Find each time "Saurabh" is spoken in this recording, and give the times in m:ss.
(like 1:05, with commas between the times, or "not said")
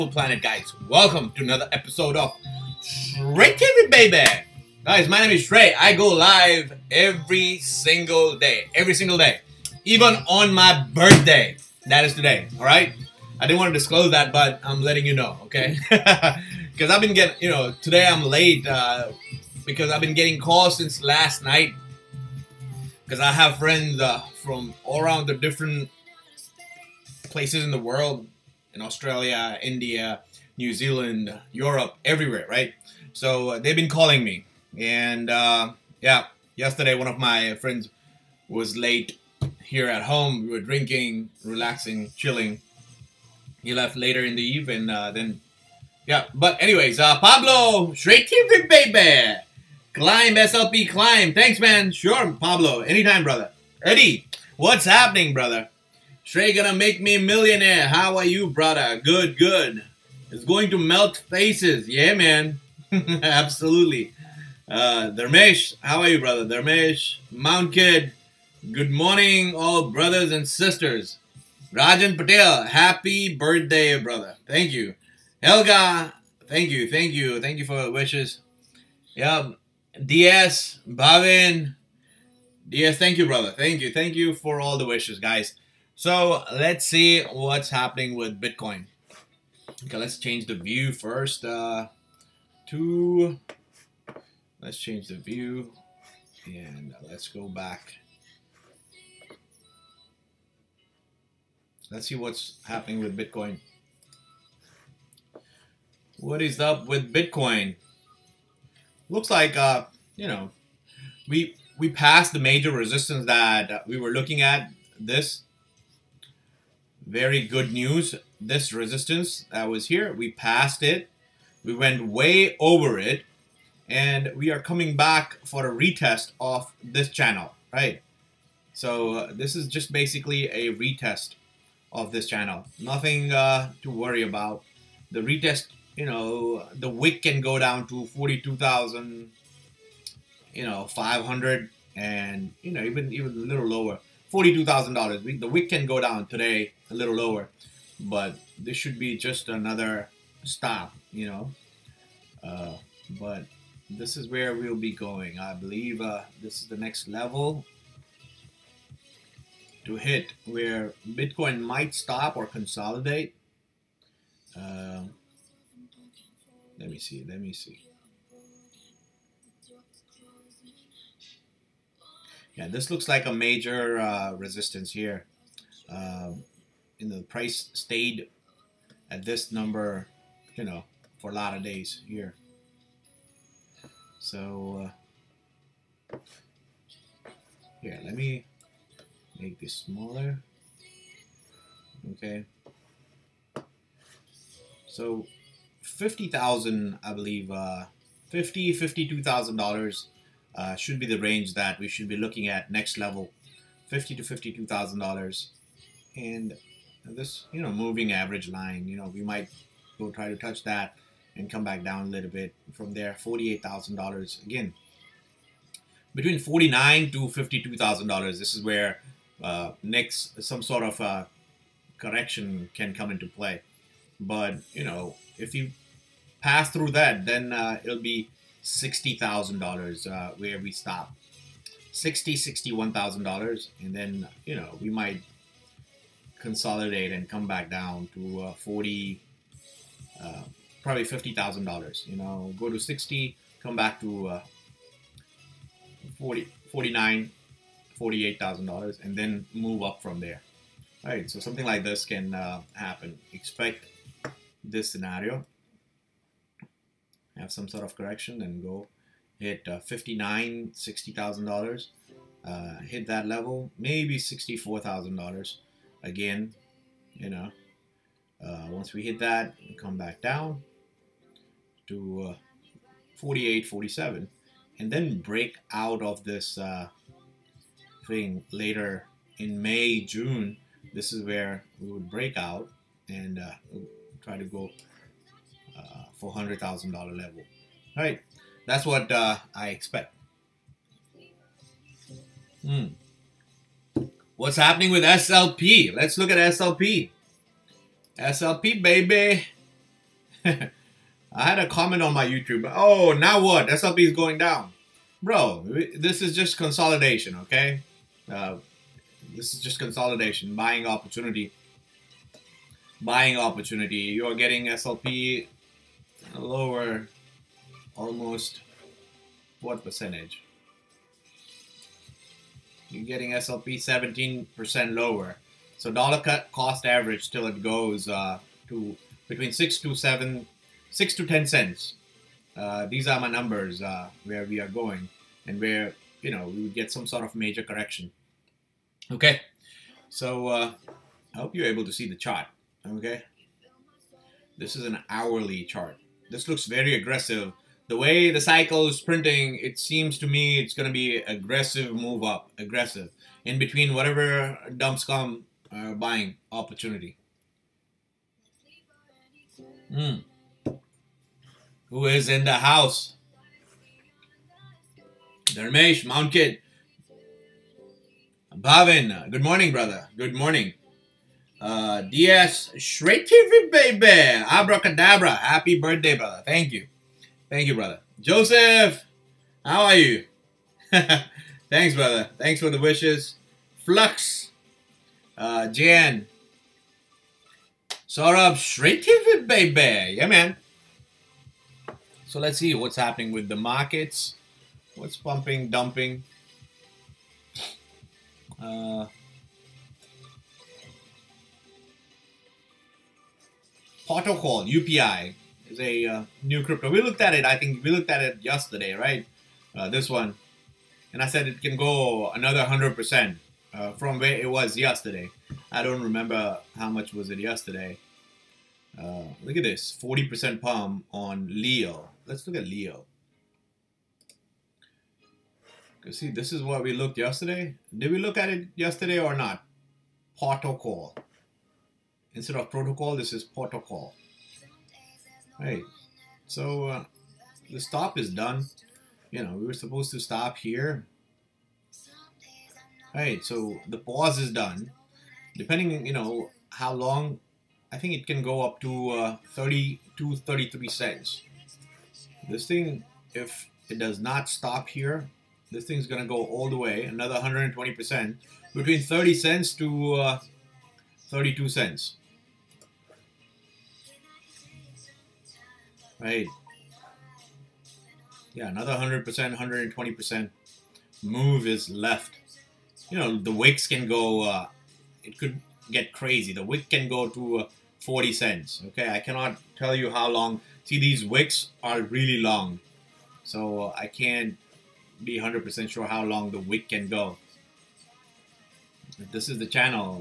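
6:28.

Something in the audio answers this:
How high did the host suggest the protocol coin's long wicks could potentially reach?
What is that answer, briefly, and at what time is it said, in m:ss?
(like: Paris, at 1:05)
40 cents, at 7:58.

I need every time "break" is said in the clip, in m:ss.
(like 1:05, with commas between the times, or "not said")
4:35, 4:42.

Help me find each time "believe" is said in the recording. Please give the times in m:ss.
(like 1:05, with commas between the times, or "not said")
2:35, 3:17.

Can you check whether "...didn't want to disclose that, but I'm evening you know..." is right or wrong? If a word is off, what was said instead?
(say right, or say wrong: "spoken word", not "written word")
wrong: "letting", not "evening".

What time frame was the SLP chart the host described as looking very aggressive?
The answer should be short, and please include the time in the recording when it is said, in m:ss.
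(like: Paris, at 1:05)
Hourly, at 5:45.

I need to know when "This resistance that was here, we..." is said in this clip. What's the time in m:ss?
1:58.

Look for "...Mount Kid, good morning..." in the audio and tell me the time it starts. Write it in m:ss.
1:07.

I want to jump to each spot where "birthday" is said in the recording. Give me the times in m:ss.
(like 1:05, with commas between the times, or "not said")
0:10, 1:13, 6:15.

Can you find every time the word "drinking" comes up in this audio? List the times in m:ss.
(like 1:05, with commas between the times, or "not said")
0:40.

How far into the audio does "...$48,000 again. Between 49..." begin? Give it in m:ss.
3:33.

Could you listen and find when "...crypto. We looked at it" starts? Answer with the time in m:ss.
6:46.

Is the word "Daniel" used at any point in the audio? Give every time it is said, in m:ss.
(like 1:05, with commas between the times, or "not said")
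not said.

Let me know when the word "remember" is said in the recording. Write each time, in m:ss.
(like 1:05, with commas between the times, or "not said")
6:56.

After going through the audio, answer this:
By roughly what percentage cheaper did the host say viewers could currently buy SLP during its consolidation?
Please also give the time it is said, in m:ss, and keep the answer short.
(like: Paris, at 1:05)
17%, at 5:23.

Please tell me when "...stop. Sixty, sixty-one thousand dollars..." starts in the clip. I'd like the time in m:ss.
3:50.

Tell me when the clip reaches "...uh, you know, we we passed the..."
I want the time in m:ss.
1:49.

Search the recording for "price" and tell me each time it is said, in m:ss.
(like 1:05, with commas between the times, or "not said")
2:57.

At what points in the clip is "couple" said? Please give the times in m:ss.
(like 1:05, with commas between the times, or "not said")
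not said.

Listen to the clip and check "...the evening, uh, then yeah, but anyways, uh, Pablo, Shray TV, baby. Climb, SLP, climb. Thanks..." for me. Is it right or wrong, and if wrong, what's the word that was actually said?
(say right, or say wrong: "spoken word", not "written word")
right.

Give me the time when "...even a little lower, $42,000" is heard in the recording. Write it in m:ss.
2:23.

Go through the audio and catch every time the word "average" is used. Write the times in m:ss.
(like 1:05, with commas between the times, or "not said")
3:28, 5:26.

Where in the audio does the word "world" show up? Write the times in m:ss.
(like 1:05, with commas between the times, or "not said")
0:27.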